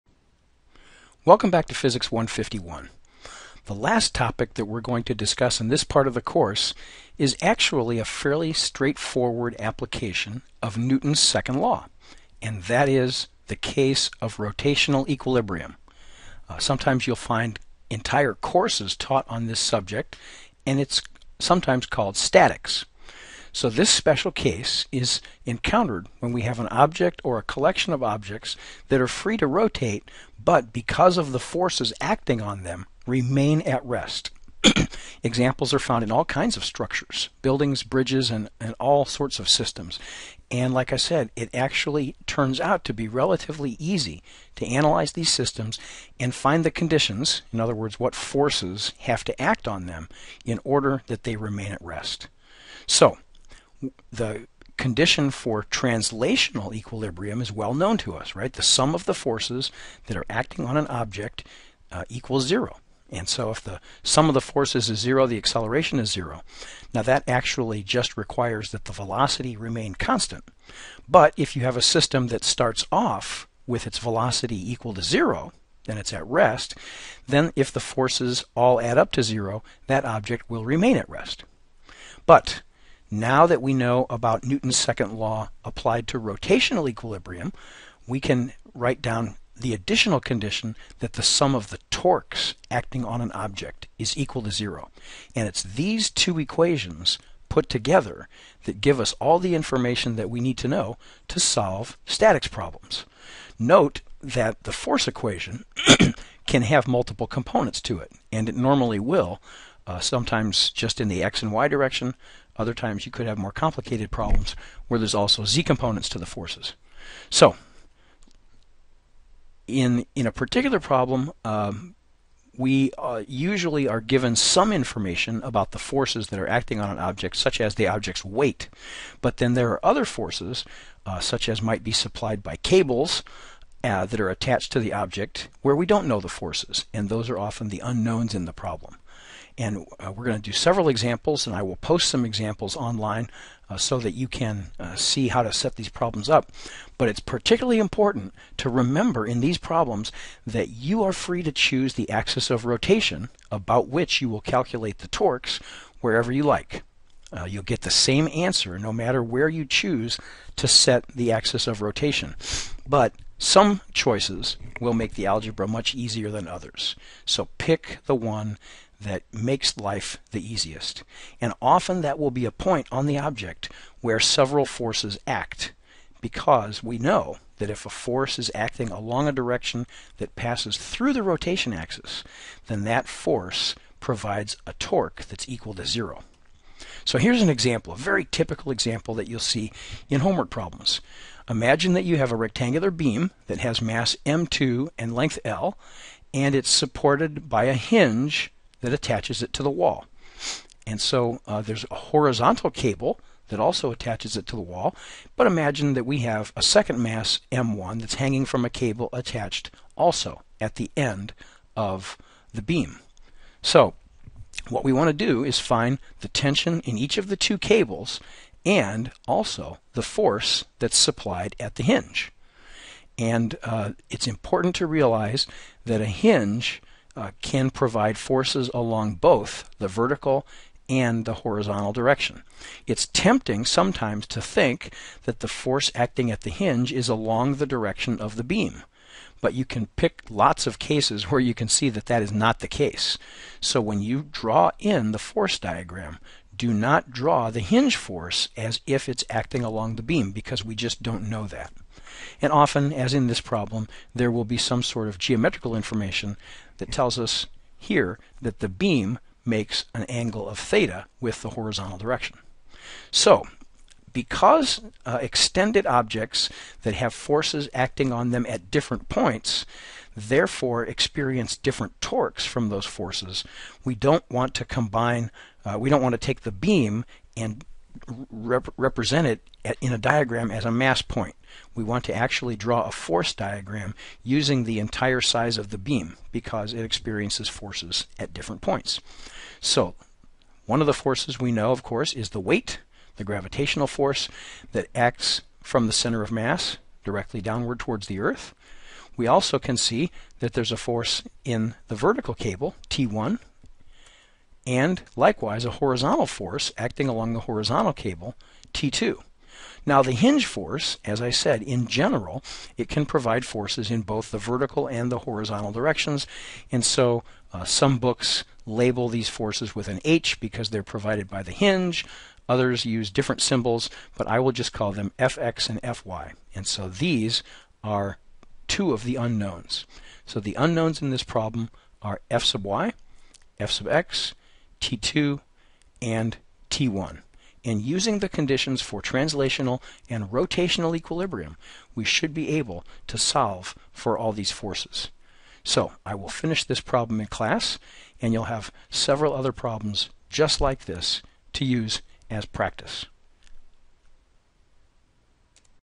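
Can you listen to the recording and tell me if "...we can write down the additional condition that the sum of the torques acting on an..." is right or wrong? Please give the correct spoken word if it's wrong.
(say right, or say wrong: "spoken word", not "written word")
right.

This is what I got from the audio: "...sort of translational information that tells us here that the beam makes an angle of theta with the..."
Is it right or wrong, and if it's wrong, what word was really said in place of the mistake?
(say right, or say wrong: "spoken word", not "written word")
wrong: "geometrical", not "translational".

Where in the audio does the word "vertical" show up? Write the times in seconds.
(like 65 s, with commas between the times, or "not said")
229 s, 301 s, 314 s.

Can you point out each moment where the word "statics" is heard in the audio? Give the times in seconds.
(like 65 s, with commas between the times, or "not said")
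22 s, 102 s.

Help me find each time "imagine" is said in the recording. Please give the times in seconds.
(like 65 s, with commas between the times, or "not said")
191 s, 205 s.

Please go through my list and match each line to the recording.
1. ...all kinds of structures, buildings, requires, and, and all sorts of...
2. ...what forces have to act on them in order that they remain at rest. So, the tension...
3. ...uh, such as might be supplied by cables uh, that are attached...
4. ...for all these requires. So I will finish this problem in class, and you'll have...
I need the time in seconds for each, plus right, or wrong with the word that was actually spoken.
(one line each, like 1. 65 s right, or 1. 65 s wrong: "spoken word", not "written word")
1. 36 s wrong: "bridges", not "requires"
2. 47 s wrong: "condition", not "tension"
3. 131 s right
4. 343 s wrong: "forces", not "requires".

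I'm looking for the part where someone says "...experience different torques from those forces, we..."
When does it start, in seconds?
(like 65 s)
270 s.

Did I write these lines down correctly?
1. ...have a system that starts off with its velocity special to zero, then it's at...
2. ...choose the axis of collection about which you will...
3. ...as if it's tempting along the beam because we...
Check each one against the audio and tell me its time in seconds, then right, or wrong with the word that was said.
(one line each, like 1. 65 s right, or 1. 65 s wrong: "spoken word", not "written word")
1. 71 s wrong: "equal", not "special"
2. 151 s wrong: "rotation", not "collection"
3. 248 s wrong: "acting", not "tempting".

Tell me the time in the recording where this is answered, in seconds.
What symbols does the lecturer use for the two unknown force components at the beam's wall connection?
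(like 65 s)
325 s.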